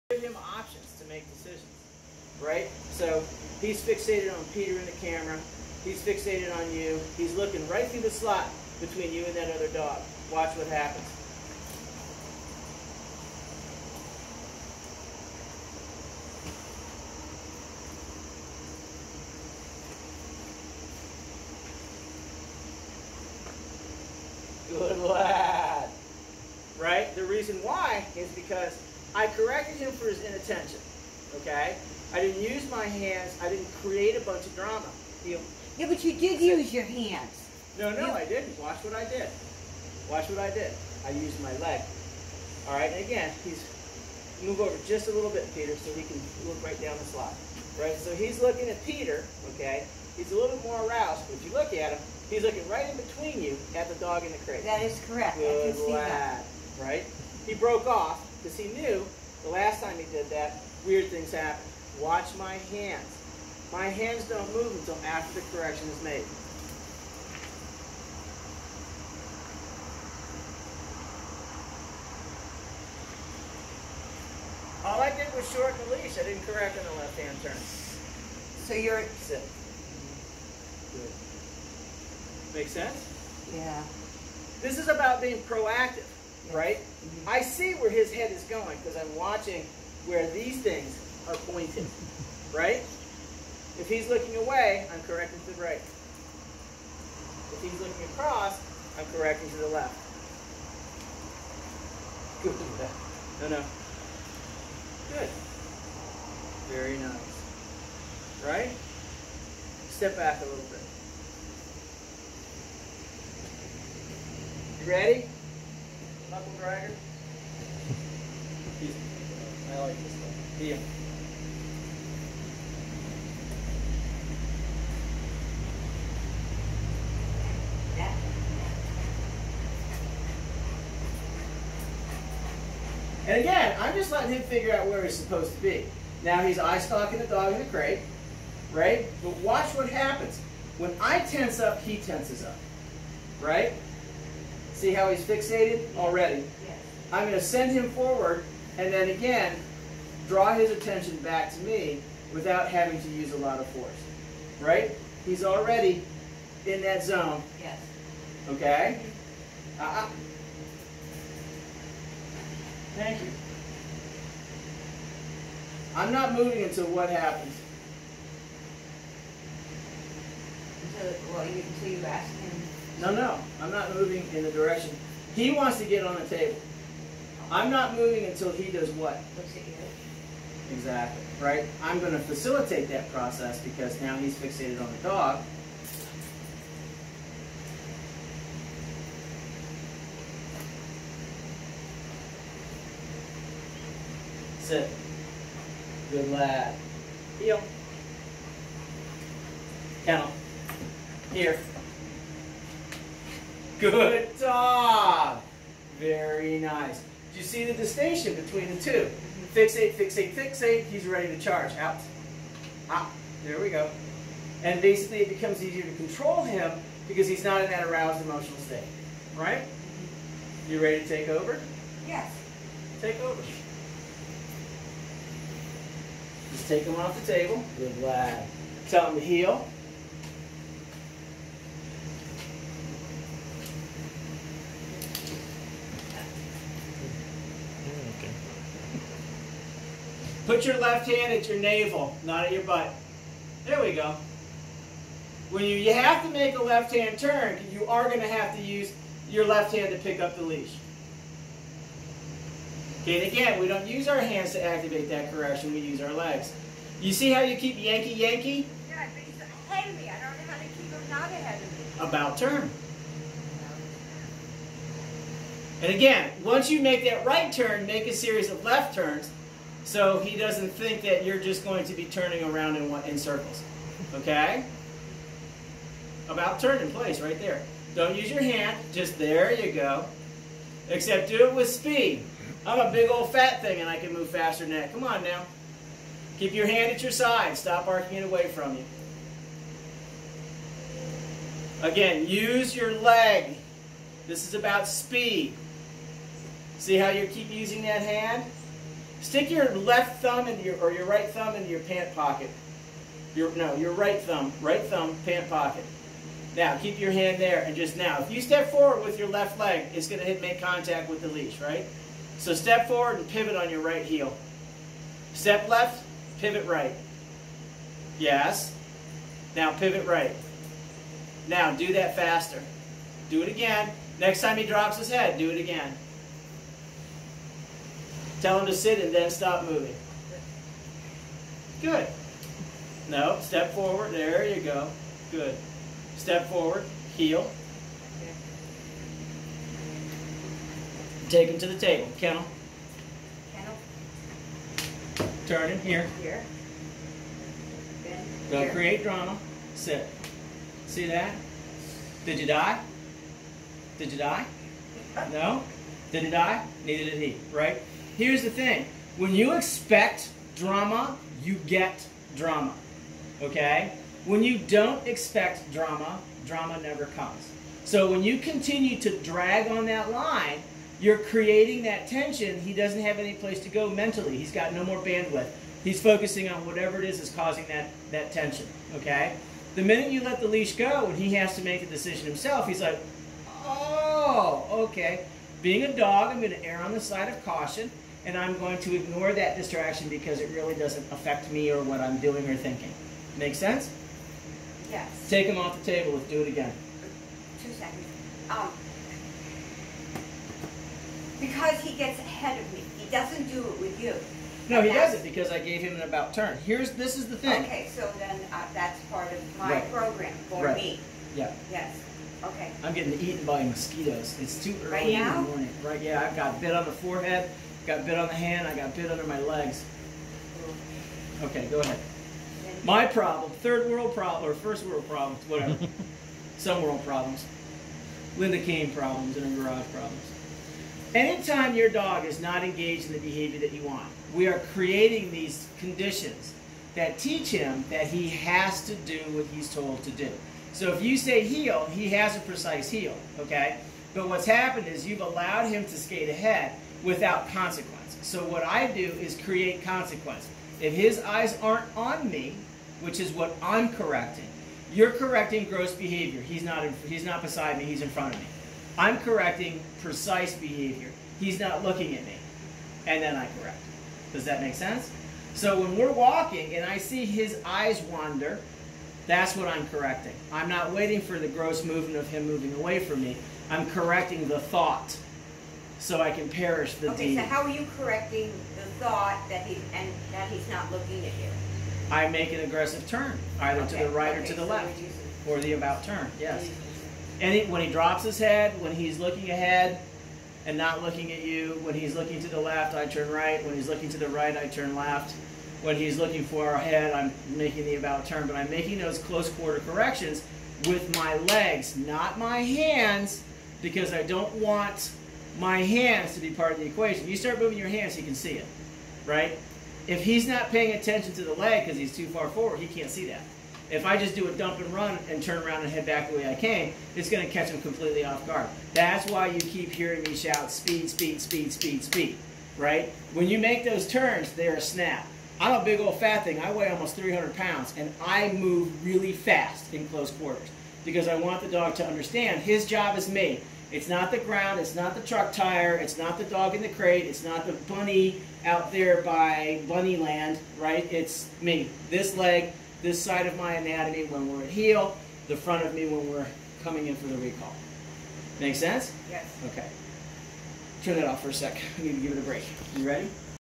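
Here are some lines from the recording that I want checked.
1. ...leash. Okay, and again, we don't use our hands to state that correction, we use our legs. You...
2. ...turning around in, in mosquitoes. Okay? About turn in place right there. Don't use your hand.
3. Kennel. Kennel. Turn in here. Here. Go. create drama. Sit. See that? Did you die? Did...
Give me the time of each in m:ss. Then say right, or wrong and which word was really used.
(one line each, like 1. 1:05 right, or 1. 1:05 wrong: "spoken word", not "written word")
1. 4:10 wrong: "activate", not "state"
2. 4:32 wrong: "circles", not "mosquitoes"
3. 5:42 right.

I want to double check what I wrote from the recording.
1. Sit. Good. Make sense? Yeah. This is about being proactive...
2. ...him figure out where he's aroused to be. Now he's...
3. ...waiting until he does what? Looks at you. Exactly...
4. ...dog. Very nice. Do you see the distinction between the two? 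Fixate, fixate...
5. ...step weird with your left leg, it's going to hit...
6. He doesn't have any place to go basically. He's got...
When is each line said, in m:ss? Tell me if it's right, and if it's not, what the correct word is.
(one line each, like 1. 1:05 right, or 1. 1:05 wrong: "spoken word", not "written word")
1. 1:19 right
2. 2:14 wrong: "supposed", not "aroused"
3. 2:57 wrong: "moving", not "waiting"
4. 3:24 right
5. 5:08 wrong: "forward", not "weird"
6. 6:12 wrong: "mentally", not "basically".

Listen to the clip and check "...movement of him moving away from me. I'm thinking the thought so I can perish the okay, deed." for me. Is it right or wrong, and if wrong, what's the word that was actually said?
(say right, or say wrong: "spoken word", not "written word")
wrong: "correcting", not "thinking".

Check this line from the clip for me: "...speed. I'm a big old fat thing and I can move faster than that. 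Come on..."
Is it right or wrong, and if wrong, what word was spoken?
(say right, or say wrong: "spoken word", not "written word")
right.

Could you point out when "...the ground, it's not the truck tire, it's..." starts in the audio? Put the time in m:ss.
8:54.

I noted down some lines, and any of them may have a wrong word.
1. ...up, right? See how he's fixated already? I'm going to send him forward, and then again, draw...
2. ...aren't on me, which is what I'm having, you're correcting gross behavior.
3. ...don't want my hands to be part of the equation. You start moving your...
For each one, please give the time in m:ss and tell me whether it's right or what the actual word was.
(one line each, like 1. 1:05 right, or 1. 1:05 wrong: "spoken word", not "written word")
1. 2:22 right
2. 7:31 wrong: "correcting", not "having"
3. 8:24 right.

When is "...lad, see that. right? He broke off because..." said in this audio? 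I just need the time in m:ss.
0:55.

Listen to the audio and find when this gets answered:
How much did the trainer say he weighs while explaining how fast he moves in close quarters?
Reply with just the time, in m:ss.
8:46.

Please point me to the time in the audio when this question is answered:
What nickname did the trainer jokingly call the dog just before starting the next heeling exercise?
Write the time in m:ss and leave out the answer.
1:56.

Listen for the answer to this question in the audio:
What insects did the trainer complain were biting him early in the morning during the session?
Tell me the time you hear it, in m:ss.
6:53.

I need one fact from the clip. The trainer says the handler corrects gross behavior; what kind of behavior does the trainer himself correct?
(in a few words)
Precise behavior.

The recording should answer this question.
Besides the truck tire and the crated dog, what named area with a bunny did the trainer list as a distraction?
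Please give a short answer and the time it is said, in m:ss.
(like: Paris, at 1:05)
Bunny land, at 8:59.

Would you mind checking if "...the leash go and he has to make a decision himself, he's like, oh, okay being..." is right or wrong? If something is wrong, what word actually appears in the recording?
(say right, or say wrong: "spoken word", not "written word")
right.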